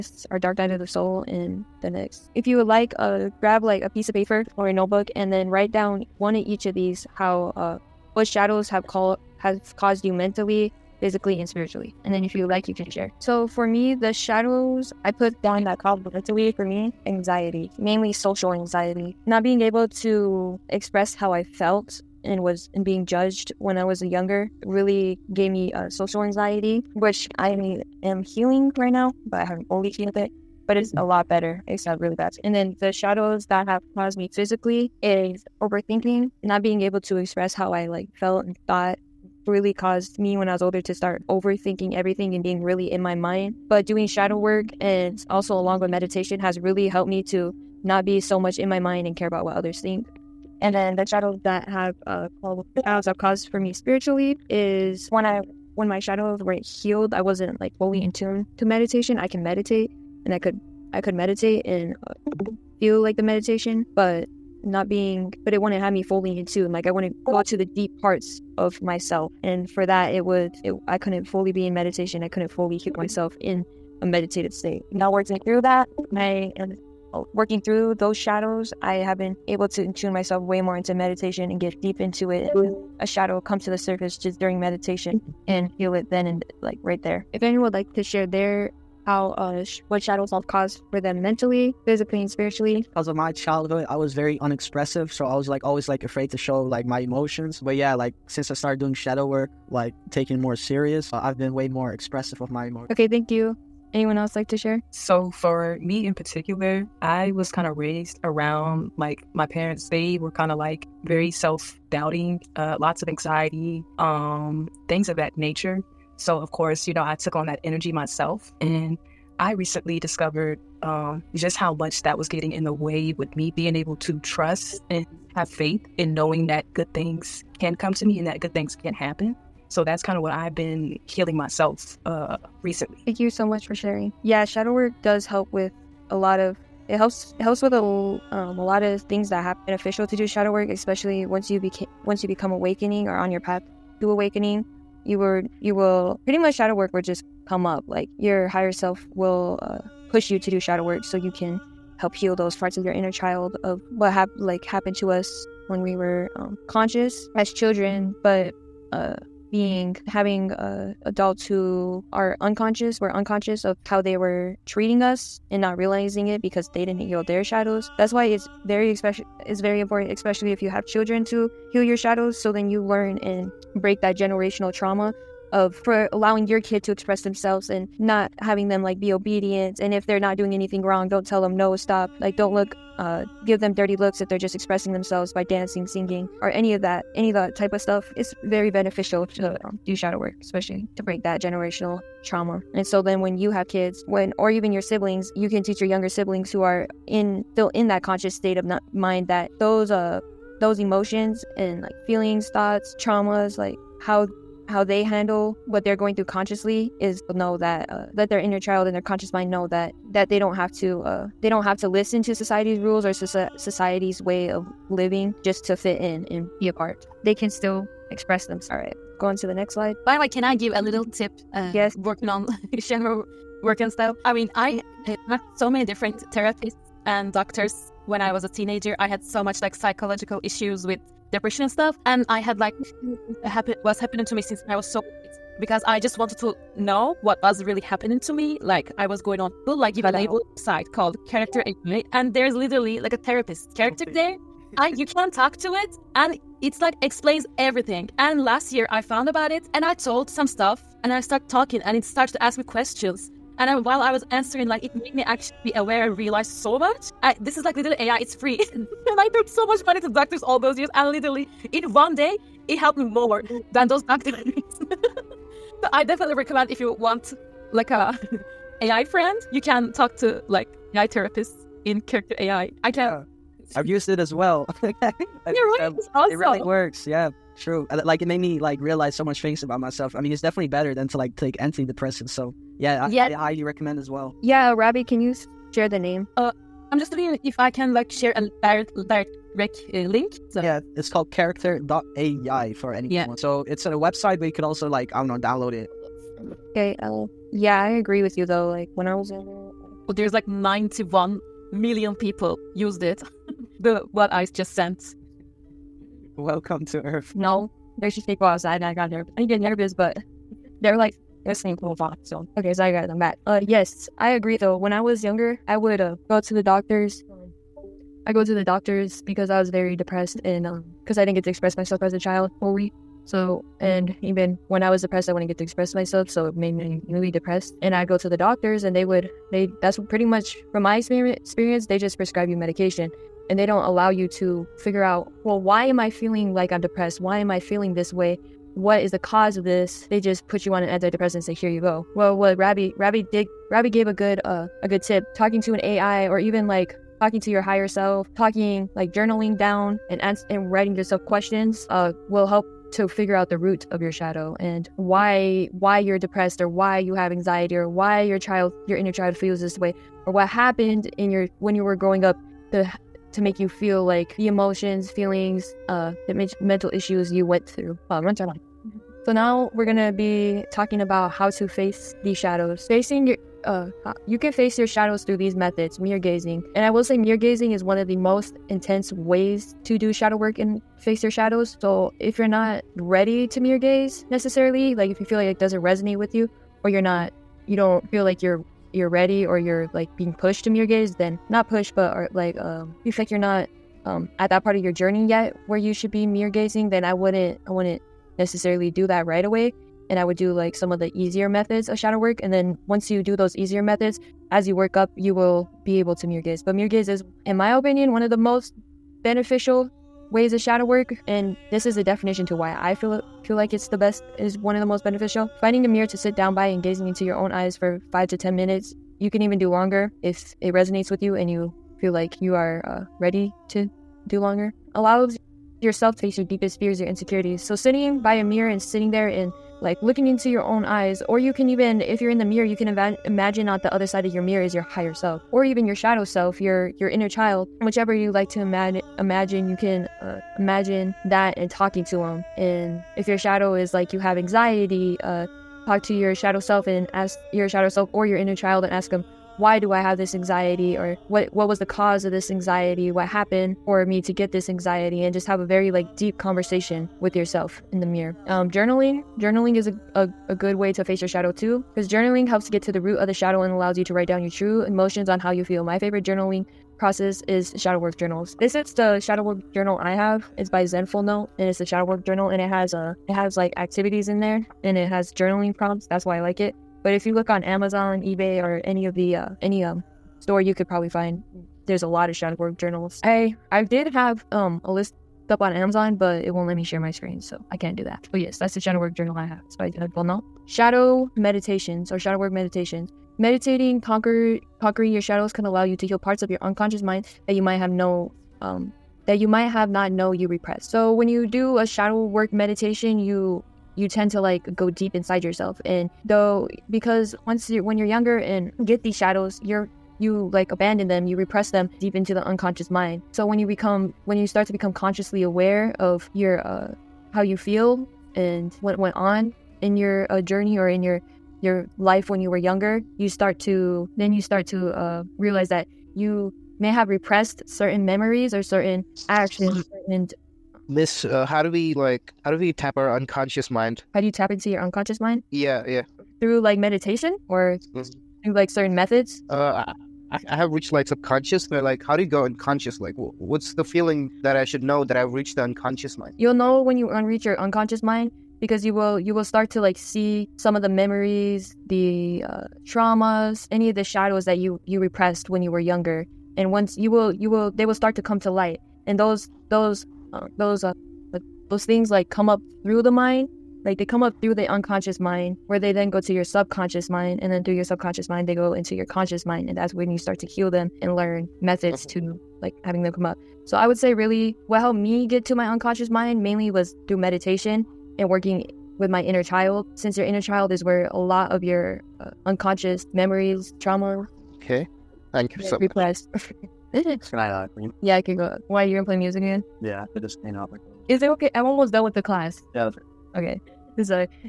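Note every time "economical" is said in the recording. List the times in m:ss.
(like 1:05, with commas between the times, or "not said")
not said.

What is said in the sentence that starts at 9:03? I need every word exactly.
Like, what's the feeling that I should know that I've reached the unconscious mind?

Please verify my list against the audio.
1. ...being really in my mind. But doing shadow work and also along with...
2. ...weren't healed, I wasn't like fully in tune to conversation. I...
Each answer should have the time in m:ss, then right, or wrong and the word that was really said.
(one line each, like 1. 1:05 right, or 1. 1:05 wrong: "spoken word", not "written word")
1. 0:42 right
2. 0:56 wrong: "meditation", not "conversation".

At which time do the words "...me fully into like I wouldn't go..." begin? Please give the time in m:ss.
1:05.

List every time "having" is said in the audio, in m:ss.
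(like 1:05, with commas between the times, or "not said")
2:40, 2:58, 9:32.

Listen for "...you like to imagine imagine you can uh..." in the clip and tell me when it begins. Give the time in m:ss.
7:18.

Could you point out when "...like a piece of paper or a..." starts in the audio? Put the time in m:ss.
0:03.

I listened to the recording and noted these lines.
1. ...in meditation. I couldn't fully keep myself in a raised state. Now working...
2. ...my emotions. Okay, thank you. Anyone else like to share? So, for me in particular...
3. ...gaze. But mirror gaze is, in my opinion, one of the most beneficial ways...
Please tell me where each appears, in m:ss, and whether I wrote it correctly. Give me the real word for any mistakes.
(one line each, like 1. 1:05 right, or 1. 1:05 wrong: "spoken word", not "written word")
1. 1:11 wrong: "meditated", not "raised"
2. 1:42 right
3. 6:46 right.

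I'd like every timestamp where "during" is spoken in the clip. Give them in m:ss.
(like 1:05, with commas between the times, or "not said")
1:24.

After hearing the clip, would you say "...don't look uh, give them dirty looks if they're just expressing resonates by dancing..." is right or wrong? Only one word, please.
wrong.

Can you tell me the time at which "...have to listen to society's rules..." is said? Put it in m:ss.
3:31.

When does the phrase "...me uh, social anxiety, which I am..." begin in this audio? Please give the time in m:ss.
0:25.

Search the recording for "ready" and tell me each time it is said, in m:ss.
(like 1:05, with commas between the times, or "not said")
6:22, 6:29, 7:03.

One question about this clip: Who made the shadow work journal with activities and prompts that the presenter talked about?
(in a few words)
Zenful Note.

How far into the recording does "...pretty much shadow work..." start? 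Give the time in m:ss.
2:26.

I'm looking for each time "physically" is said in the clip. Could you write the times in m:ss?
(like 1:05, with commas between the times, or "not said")
0:11, 0:34, 1:31.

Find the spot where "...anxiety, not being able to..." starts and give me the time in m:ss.
0:18.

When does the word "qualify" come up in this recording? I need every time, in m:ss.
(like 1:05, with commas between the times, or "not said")
not said.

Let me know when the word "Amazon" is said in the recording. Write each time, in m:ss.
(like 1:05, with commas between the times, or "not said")
7:57, 8:05.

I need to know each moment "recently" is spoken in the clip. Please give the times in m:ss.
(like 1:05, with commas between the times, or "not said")
1:59, 2:12.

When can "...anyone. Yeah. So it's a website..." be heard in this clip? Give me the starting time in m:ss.
4:52.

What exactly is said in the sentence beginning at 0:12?
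And then if you like, you can share.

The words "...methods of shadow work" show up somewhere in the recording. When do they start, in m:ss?
6:41.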